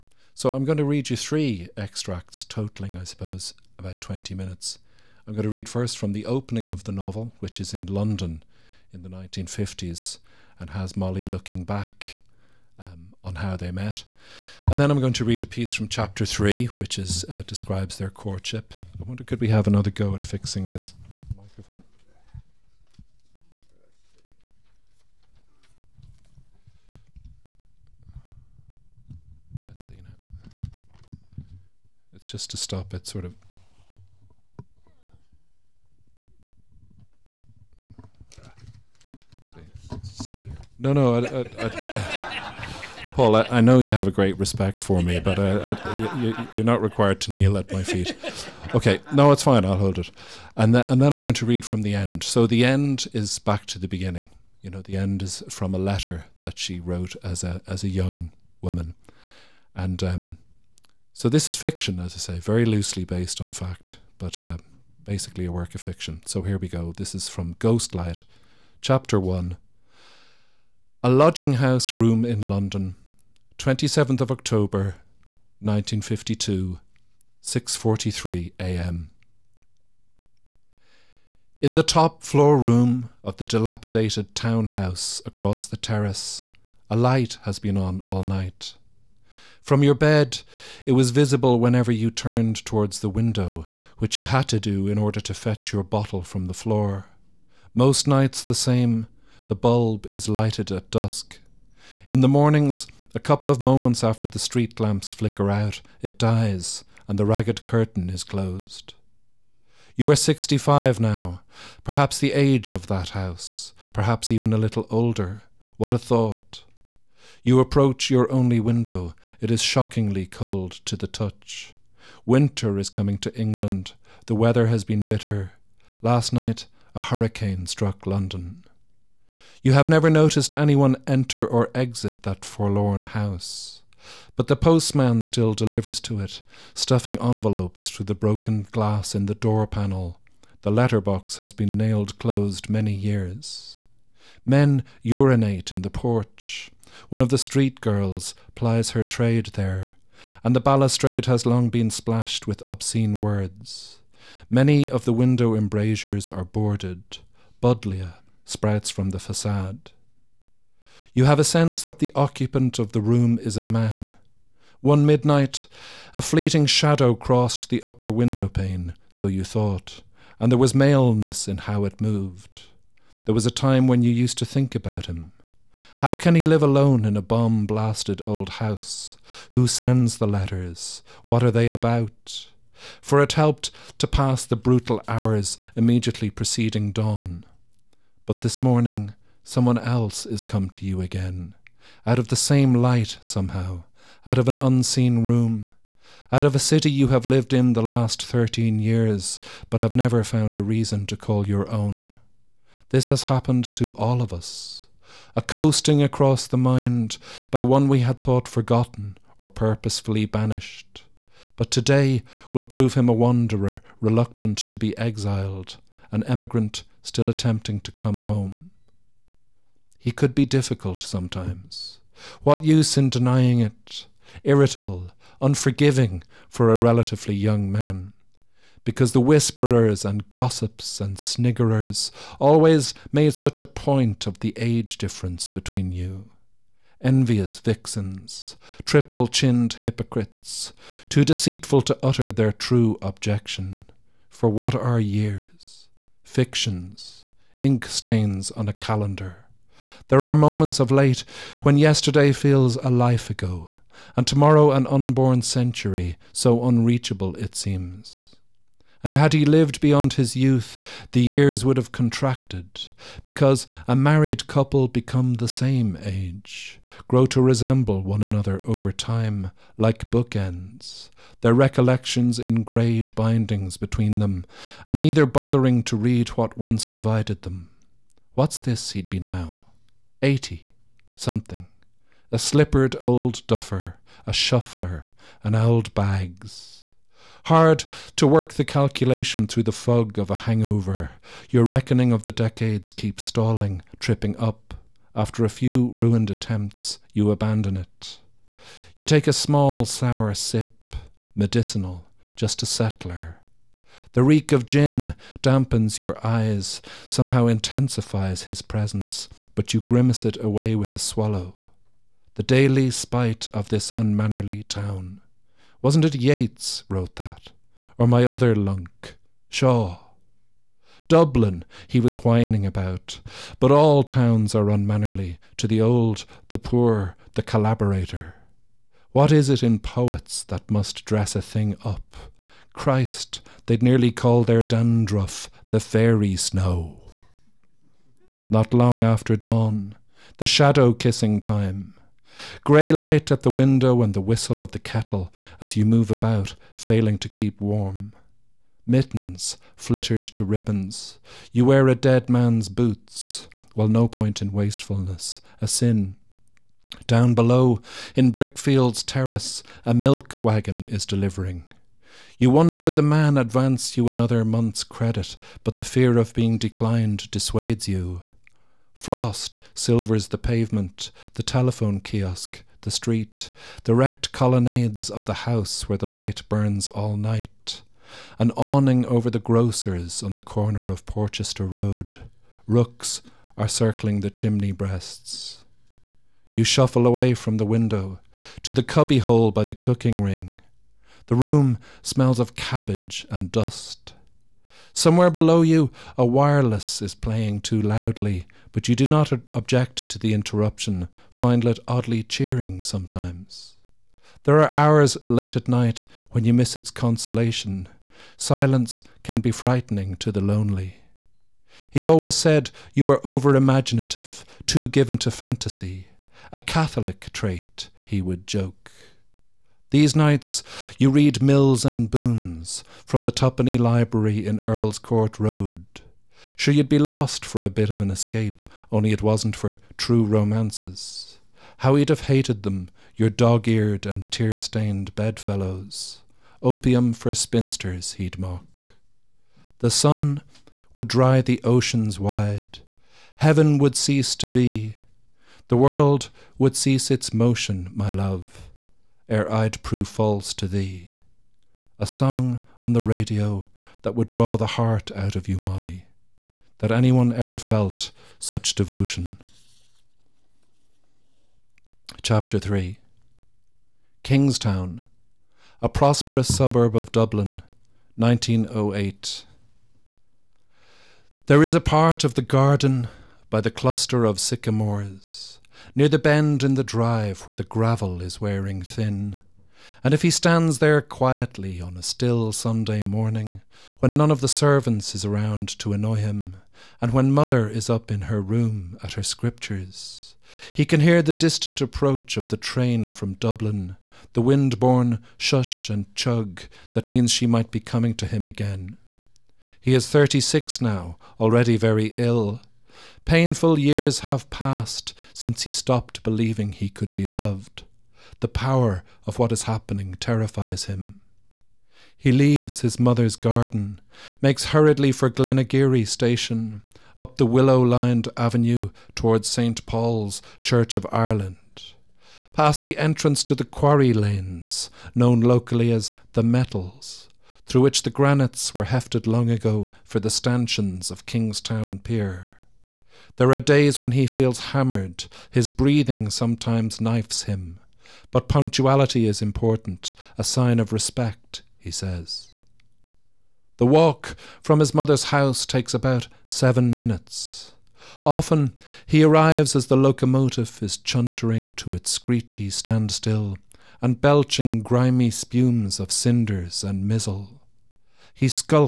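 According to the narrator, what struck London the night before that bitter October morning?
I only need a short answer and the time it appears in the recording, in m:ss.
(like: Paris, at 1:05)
A hurricane, at 2:06.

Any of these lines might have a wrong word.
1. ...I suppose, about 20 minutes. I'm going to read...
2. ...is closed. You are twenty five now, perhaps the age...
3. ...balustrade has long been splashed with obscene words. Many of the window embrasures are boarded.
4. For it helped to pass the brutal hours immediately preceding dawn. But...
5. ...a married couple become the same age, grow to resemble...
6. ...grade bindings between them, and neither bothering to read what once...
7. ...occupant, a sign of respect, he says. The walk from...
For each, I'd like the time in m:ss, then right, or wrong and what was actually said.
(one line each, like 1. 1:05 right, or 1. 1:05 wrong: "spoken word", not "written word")
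1. 0:02 right
2. 1:48 wrong: "sixty", not "twenty"
3. 2:30 right
4. 3:02 right
5. 4:23 right
6. 4:32 right
7. 8:59 wrong: "important", not "occupant".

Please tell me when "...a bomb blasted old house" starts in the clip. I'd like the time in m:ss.
2:57.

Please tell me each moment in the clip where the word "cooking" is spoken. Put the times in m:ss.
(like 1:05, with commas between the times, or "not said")
6:29.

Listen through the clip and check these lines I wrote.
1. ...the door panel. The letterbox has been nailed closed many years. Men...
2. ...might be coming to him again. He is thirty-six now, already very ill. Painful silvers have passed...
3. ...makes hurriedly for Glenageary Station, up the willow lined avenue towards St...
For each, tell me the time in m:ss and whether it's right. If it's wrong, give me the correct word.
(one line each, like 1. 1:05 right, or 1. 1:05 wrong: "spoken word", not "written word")
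1. 2:19 right
2. 8:17 wrong: "years", not "silvers"
3. 8:34 right.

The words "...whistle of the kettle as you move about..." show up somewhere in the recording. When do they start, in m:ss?
5:44.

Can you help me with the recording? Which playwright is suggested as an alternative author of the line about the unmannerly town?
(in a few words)
Shaw.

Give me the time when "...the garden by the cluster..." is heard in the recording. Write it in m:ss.
7:52.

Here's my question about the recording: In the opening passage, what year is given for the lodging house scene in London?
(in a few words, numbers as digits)
1952.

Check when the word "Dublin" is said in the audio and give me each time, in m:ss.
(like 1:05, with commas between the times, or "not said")
5:21, 7:47, 8:13.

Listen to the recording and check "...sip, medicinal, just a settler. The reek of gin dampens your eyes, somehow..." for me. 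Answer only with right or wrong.
right.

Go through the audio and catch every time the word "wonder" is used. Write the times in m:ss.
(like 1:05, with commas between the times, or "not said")
0:19, 6:02.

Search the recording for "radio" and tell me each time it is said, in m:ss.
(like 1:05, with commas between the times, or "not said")
7:33.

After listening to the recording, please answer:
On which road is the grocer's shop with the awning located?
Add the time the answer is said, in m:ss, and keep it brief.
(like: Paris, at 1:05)
Porchester Road, at 6:21.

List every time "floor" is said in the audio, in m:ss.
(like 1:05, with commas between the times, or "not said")
1:22, 1:36.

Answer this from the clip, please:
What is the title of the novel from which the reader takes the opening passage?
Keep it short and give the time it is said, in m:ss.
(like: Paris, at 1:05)
Ghost Light, at 1:07.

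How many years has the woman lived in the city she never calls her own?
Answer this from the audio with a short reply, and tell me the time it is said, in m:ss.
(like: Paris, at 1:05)
13, at 3:18.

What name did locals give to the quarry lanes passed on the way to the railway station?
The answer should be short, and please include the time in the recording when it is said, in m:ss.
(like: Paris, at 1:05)
the Metals, at 8:46.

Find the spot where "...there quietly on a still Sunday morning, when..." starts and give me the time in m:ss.
8:00.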